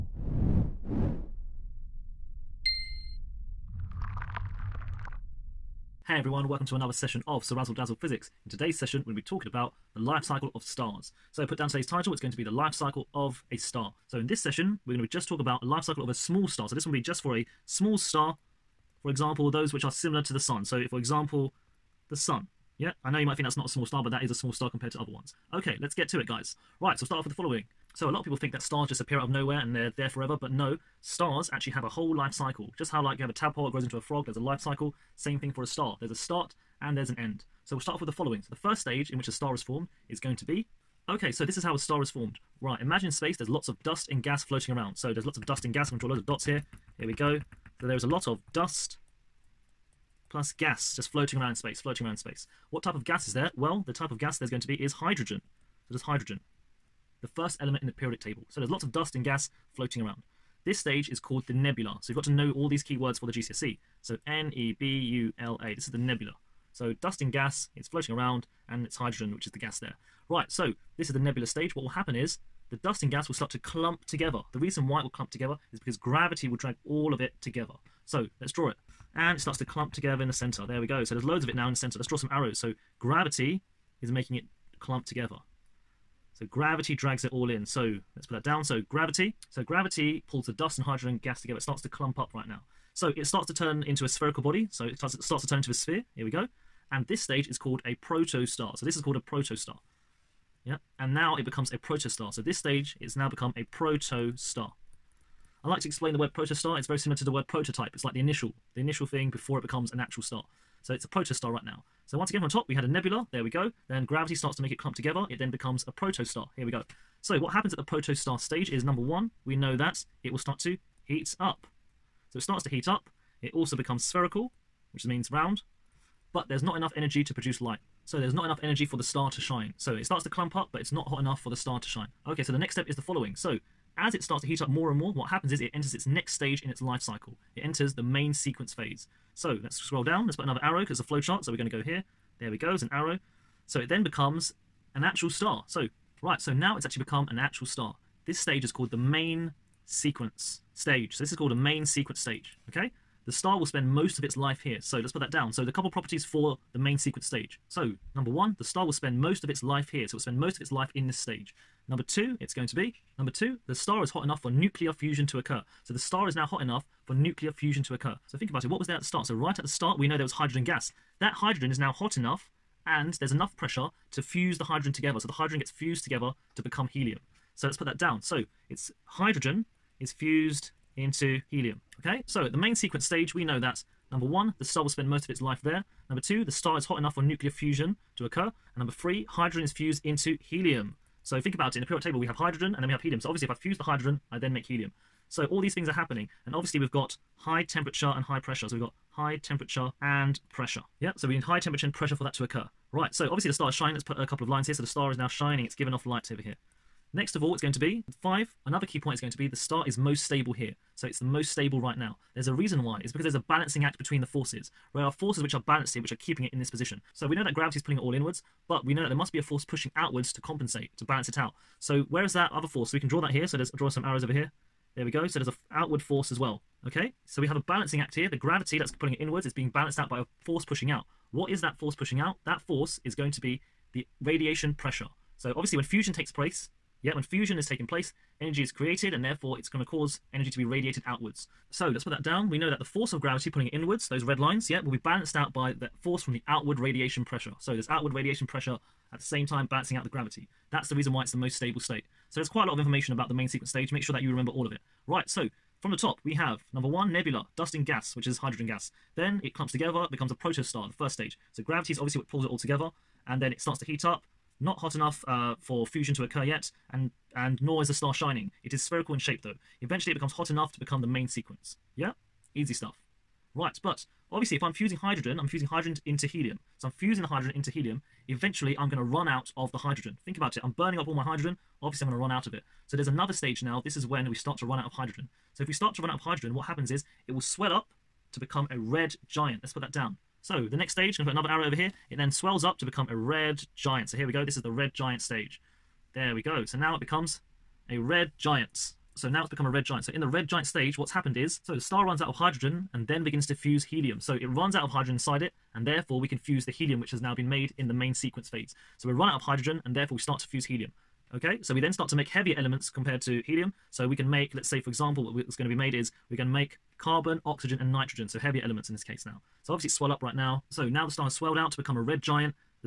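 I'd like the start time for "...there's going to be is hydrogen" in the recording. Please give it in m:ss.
0:54.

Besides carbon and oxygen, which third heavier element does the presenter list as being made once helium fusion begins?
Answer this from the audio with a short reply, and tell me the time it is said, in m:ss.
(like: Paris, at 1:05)
Nitrogen, at 5:17.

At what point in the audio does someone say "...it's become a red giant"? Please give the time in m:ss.
4:59.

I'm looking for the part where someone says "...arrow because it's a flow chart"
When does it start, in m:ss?
2:20.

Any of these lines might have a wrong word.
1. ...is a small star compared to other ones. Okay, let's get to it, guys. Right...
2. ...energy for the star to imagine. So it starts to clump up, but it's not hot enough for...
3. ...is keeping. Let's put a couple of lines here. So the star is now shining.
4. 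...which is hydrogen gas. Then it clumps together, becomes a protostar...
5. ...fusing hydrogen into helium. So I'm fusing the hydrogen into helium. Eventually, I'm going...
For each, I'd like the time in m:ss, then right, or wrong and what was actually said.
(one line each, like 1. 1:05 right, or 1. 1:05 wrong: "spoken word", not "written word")
1. 0:24 right
2. 2:08 wrong: "shine", not "imagine"
3. 3:23 wrong: "shining", not "keeping"
4. 4:18 right
5. 4:35 right.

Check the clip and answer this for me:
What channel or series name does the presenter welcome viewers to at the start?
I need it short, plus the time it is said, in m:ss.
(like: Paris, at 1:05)
CeerazzleDazzle Physics, at 0:07.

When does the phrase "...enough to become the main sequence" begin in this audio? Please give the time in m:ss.
4:30.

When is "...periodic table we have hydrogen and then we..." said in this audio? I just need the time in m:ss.
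3:11.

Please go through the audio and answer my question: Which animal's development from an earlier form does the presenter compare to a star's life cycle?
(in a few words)
Frog.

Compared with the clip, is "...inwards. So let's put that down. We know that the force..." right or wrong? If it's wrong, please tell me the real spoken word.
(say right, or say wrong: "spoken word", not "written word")
wrong: "outwards", not "inwards".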